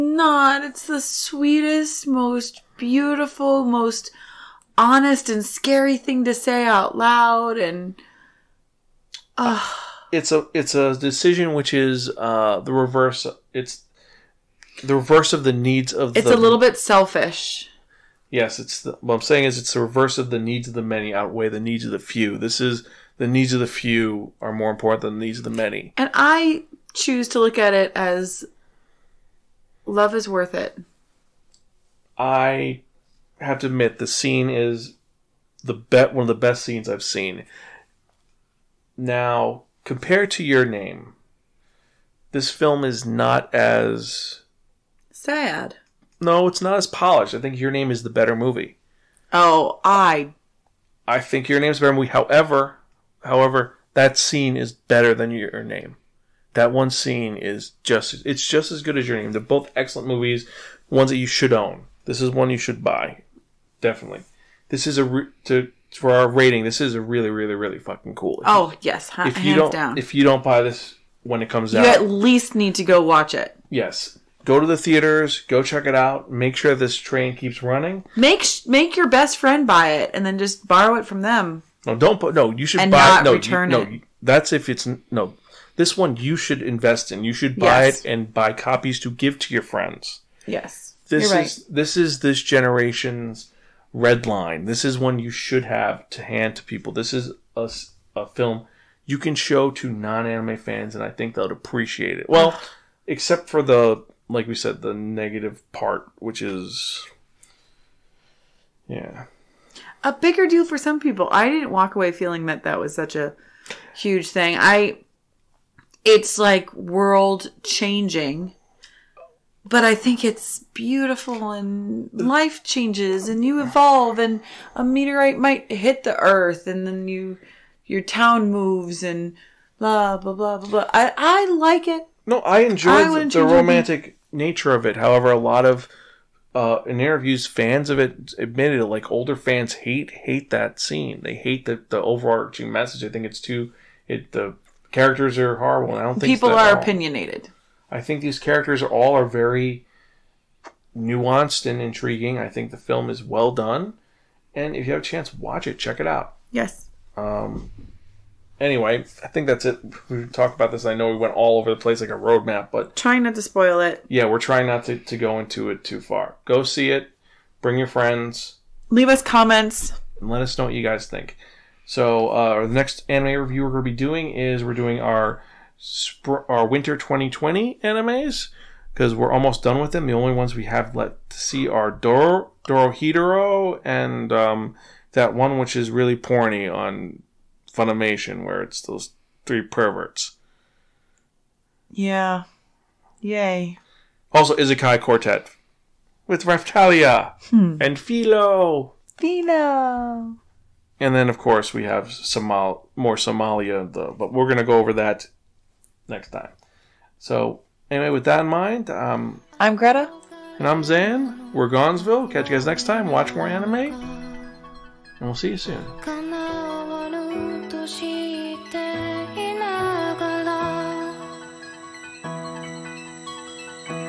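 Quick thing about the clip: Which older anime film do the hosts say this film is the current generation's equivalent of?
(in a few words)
Red Line.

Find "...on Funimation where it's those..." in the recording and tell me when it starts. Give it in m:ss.
3:06.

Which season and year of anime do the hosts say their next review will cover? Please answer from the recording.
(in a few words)
Winter 2020.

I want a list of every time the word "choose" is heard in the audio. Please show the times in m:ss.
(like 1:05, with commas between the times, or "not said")
0:26.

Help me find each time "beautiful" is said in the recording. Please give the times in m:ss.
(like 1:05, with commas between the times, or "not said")
0:02, 2:00.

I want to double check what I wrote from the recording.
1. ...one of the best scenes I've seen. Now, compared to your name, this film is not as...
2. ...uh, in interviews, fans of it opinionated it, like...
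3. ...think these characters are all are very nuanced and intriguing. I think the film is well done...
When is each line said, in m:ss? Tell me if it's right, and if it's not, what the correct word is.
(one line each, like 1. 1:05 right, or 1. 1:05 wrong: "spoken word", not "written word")
1. 0:36 right
2. 2:16 wrong: "admitted", not "opinionated"
3. 2:28 right.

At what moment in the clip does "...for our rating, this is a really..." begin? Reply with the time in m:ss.
1:05.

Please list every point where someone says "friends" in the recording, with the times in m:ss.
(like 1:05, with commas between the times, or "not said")
1:19, 1:29, 2:47.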